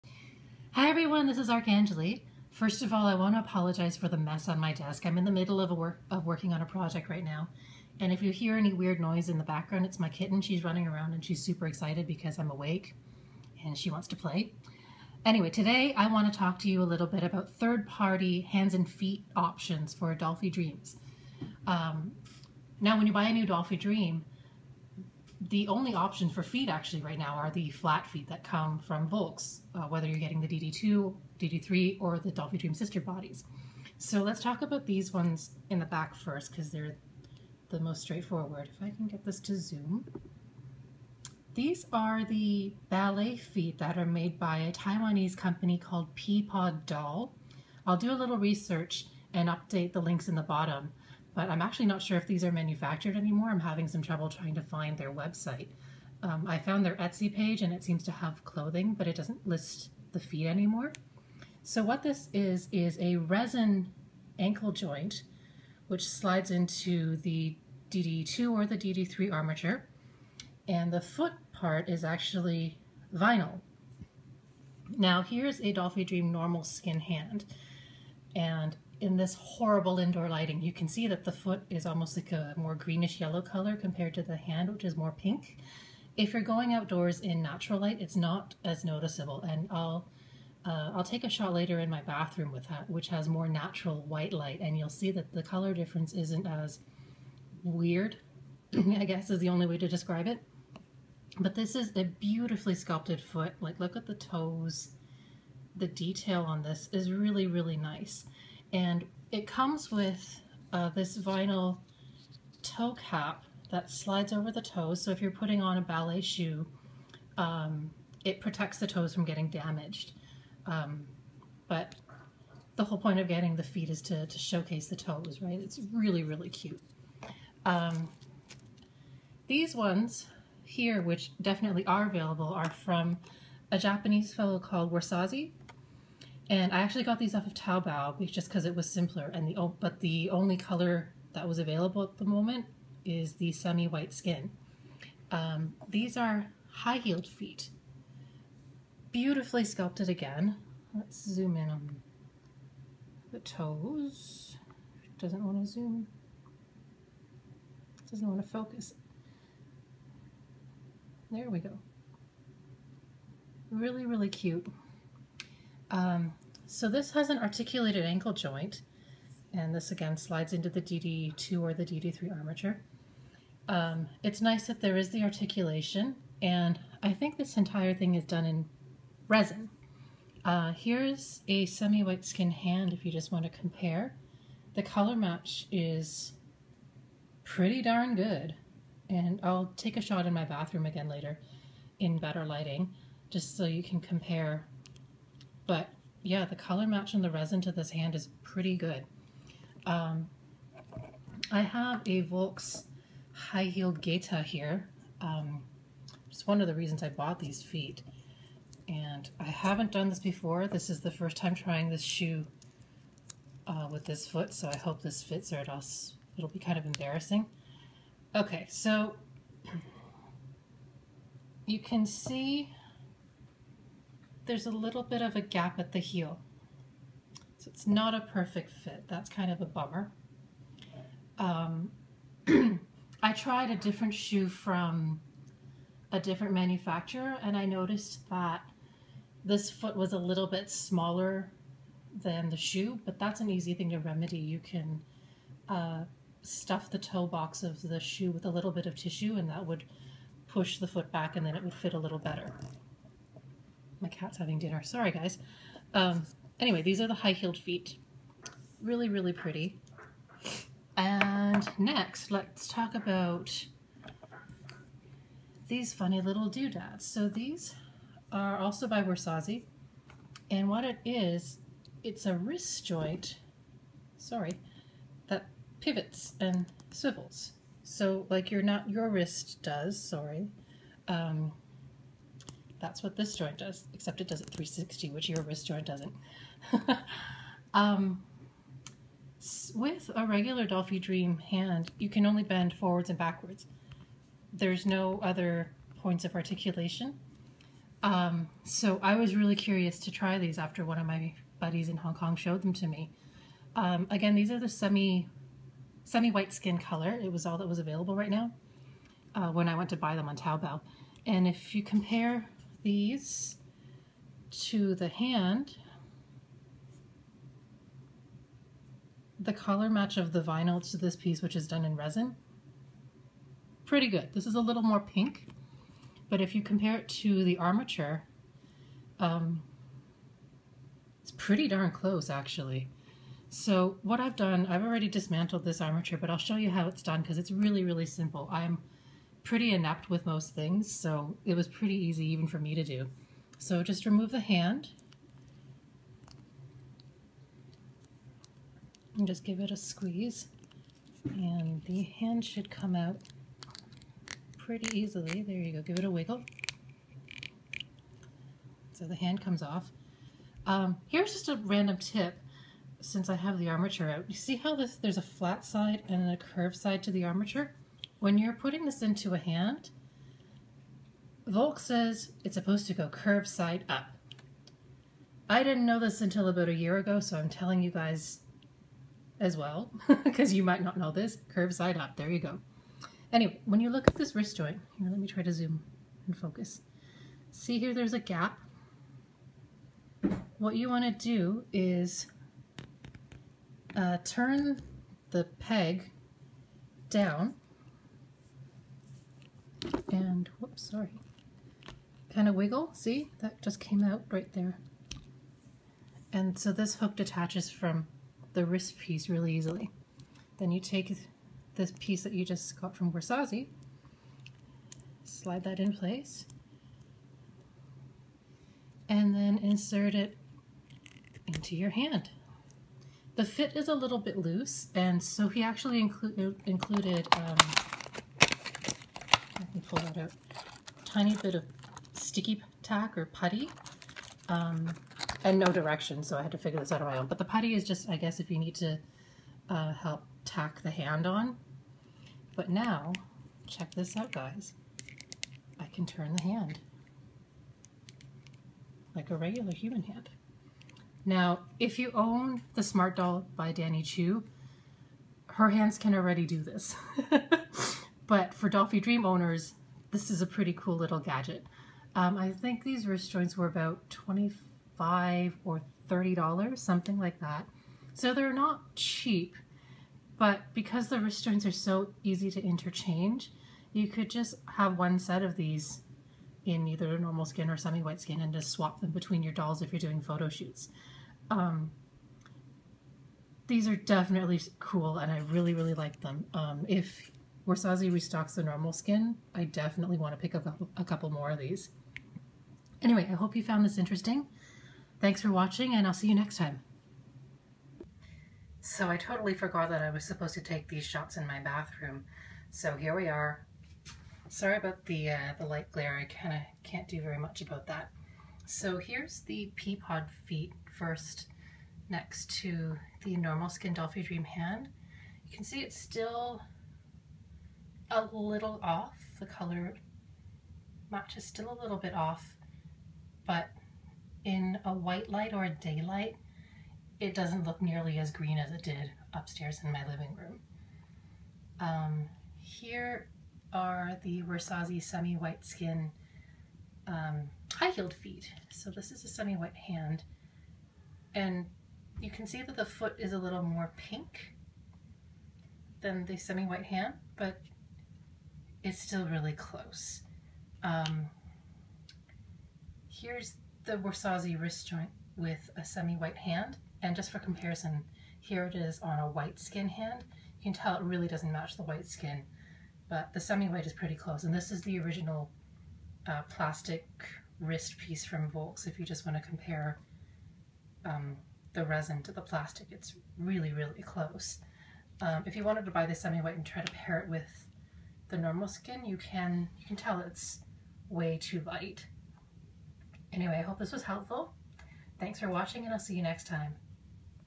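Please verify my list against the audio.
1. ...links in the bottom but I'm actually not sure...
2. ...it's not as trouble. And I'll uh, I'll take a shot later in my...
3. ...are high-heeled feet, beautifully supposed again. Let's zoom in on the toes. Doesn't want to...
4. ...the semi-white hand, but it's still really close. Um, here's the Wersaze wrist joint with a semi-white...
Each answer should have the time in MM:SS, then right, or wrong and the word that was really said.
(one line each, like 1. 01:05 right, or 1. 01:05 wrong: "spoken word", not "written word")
1. 00:50 right
2. 01:27 wrong: "noticeable", not "trouble"
3. 02:26 wrong: "sculpted", not "supposed"
4. 09:06 right.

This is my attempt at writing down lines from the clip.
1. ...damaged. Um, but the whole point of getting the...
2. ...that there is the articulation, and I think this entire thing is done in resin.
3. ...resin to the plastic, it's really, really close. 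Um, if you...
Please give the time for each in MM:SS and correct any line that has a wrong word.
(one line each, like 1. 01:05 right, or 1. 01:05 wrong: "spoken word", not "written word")
1. 01:59 right
2. 02:54 right
3. 09:31 right.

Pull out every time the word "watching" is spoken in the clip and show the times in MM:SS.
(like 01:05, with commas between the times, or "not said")
08:15, 09:45.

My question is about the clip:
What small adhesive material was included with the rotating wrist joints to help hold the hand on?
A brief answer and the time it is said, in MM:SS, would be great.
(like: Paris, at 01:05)
sticky tack, at 07:12.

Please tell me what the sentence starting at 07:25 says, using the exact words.
I can turn the hand like a regular human hand.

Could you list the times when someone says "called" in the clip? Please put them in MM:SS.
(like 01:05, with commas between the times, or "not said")
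00:45, 02:14.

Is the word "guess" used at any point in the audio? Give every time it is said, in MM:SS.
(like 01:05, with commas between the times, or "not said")
01:39, 07:18.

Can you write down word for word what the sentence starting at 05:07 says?
It was all that was available right now uh, when I went to buy them on Taobao.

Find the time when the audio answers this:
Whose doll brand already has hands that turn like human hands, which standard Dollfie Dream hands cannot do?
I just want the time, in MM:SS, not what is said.
07:33.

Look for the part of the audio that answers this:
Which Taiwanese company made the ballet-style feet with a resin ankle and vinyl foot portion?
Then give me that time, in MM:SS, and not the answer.
00:46.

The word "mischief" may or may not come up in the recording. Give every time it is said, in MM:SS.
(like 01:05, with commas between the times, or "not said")
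not said.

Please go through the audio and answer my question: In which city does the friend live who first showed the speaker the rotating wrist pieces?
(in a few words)
Hong Kong.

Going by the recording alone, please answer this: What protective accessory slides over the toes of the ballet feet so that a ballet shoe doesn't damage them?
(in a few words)
vinyl toe cap.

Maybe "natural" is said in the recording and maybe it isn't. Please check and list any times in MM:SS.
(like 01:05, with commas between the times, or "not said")
01:27, 01:33.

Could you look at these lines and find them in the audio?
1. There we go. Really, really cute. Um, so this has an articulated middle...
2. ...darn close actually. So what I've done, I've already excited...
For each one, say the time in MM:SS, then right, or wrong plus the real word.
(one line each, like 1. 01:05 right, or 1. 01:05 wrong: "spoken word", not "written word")
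1. 02:41 wrong: "ankle", not "middle"
2. 05:31 wrong: "dismantled", not "excited".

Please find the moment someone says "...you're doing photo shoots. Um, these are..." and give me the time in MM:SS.
07:59.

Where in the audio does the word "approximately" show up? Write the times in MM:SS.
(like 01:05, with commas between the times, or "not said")
not said.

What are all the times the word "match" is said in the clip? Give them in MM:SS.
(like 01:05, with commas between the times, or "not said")
03:05, 03:16, 05:19, 08:41, 09:21.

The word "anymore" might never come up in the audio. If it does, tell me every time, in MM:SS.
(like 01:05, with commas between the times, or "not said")
00:53, 01:00.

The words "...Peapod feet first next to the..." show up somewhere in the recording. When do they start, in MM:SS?
08:29.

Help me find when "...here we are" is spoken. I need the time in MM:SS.
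08:22.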